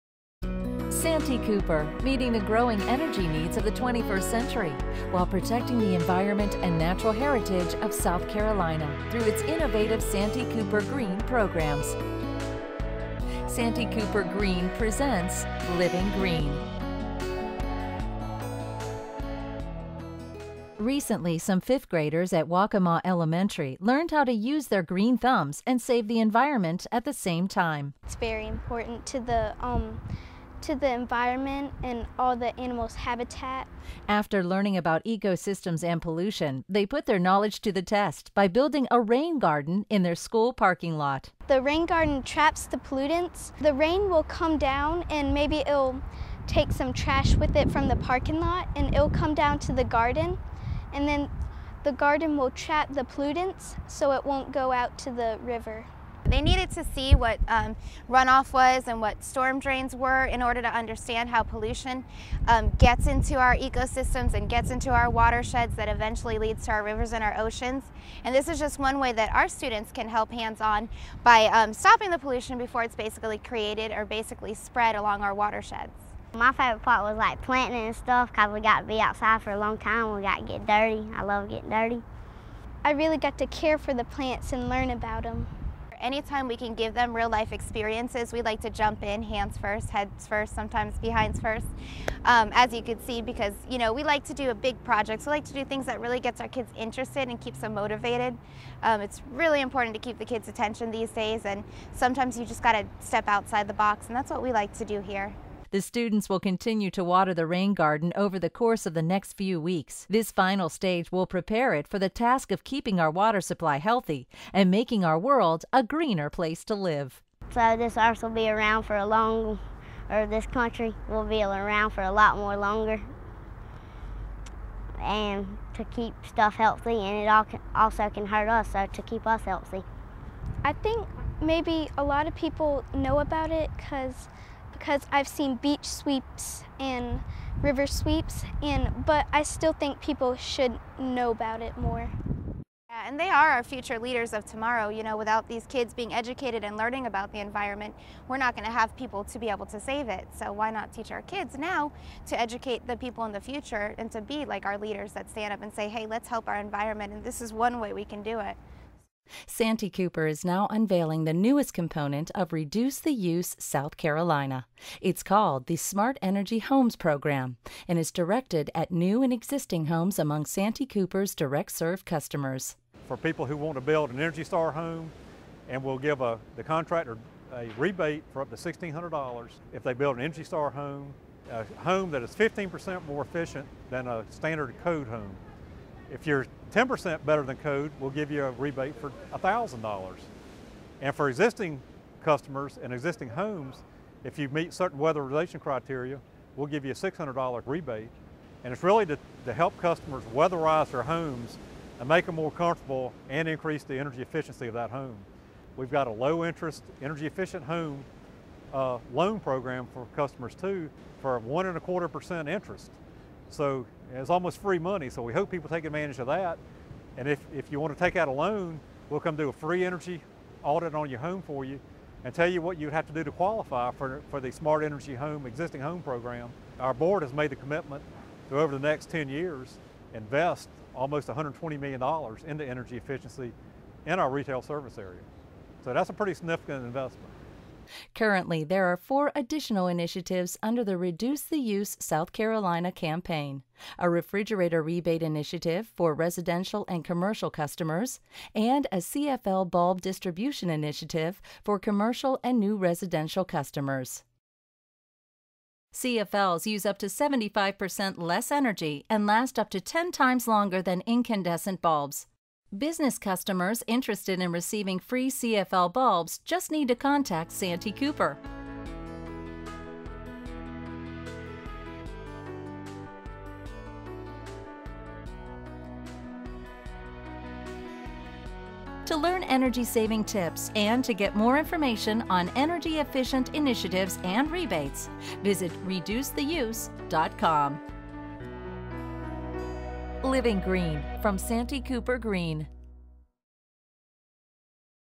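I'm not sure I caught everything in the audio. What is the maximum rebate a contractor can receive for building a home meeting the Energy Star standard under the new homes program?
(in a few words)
$1,600.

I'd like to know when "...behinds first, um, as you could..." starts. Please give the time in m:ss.
1:30.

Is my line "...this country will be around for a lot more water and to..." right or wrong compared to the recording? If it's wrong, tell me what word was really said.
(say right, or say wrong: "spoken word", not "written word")
wrong: "longer", not "water".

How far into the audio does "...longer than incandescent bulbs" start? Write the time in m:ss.
4:20.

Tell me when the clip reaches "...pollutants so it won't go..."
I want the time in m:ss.
0:53.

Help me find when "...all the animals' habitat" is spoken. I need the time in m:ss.
0:32.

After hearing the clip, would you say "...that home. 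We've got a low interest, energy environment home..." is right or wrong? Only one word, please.
wrong.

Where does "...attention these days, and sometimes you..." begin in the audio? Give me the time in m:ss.
1:40.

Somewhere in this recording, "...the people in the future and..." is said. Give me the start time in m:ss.
2:32.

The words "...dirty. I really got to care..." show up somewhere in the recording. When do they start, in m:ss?
1:21.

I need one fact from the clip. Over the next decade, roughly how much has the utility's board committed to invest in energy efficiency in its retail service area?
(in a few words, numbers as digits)
almost $120 million.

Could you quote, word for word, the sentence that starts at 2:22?
Yeah, and they are our future leaders of tomorrow.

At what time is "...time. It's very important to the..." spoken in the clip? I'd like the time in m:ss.
0:27.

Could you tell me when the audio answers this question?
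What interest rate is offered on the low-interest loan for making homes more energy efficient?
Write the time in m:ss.
3:31.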